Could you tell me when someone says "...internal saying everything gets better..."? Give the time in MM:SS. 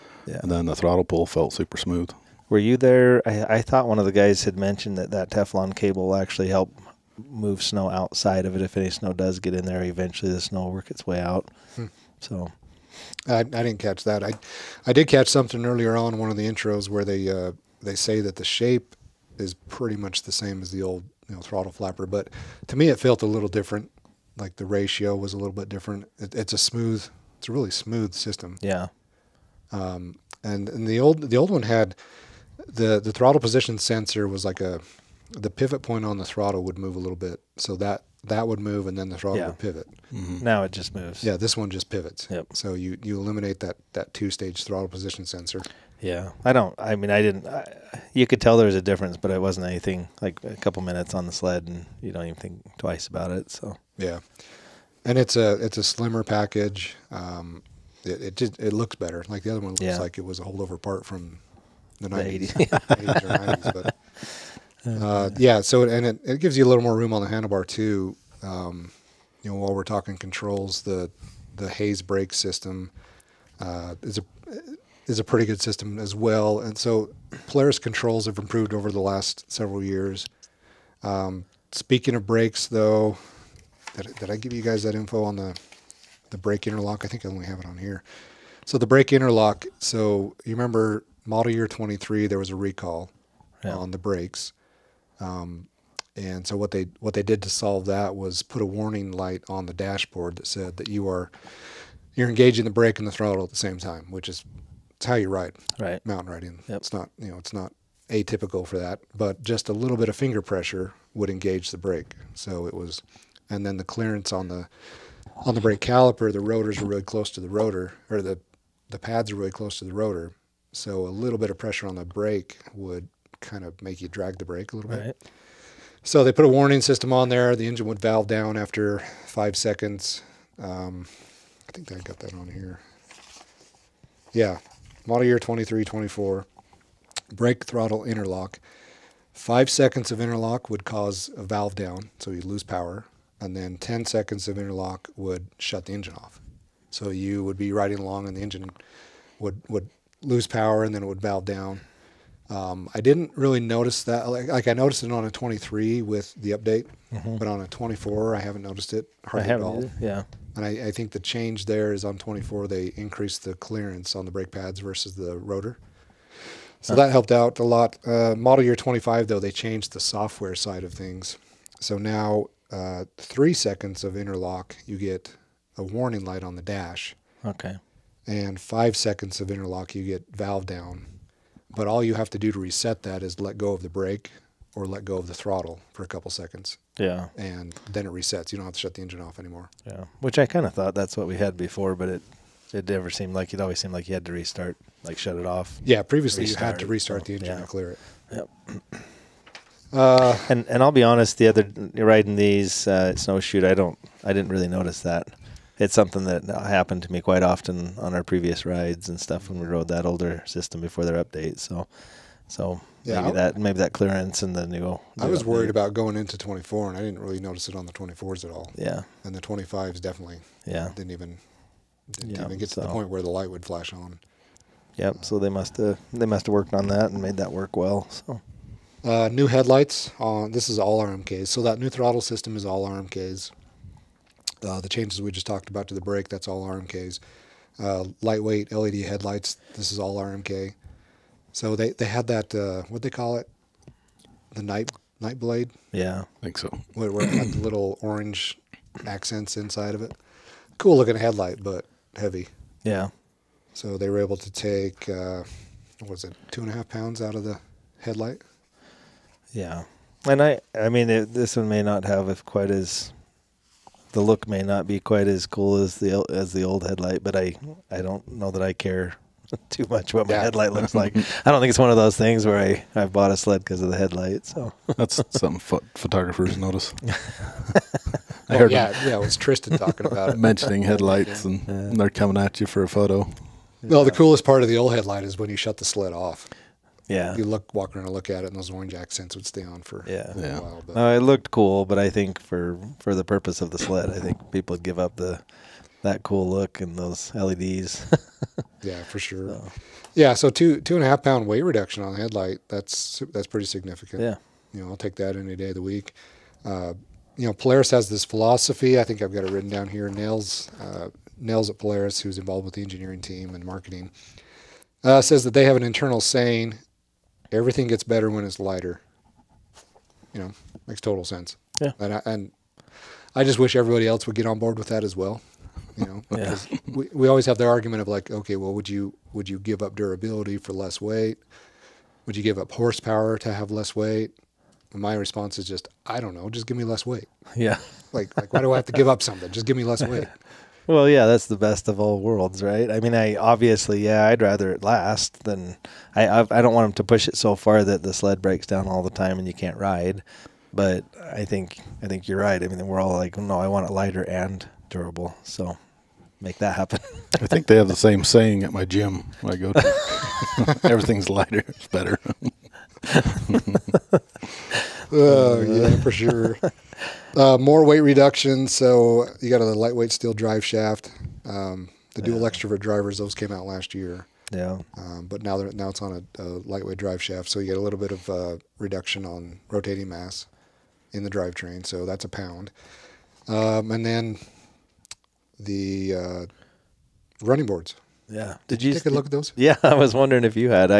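05:15.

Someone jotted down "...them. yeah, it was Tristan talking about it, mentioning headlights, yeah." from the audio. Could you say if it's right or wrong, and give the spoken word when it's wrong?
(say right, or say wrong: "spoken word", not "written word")
right.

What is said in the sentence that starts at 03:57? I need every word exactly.
Uh, lightweight LED headlights, this is all RMK.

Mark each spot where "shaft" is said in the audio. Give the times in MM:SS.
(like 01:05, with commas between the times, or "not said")
06:10, 06:17.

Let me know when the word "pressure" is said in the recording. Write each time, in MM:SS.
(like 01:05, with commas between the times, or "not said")
01:50, 02:01.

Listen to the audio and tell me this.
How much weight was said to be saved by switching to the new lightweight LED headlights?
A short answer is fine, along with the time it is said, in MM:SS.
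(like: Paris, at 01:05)
2.5 pounds, at 04:16.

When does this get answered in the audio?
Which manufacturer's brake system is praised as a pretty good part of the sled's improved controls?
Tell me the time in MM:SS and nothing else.
01:11.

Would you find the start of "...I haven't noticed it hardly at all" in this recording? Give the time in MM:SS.
02:38.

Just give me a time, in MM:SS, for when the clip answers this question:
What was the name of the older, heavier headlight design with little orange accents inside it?
04:05.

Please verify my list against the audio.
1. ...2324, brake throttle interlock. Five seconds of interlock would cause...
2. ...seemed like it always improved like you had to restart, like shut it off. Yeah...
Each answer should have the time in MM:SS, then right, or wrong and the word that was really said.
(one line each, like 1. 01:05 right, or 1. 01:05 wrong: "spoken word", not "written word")
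1. 02:15 right
2. 03:13 wrong: "seemed", not "improved".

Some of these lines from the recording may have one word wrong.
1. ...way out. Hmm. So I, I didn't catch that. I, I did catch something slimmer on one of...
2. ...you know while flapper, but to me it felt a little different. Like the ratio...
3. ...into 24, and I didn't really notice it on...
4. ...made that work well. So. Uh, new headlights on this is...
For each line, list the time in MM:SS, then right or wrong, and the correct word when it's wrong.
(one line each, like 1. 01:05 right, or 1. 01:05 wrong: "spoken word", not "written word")
1. 00:11 wrong: "earlier", not "slimmer"
2. 00:21 wrong: "throttle", not "while"
3. 03:36 right
4. 03:47 right.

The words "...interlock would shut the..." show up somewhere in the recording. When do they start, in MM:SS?
02:24.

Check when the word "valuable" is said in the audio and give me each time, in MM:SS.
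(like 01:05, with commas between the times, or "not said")
not said.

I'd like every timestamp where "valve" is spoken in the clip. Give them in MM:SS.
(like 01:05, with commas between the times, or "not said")
02:07, 02:21, 02:31, 03:00.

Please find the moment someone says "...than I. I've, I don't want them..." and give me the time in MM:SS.
05:45.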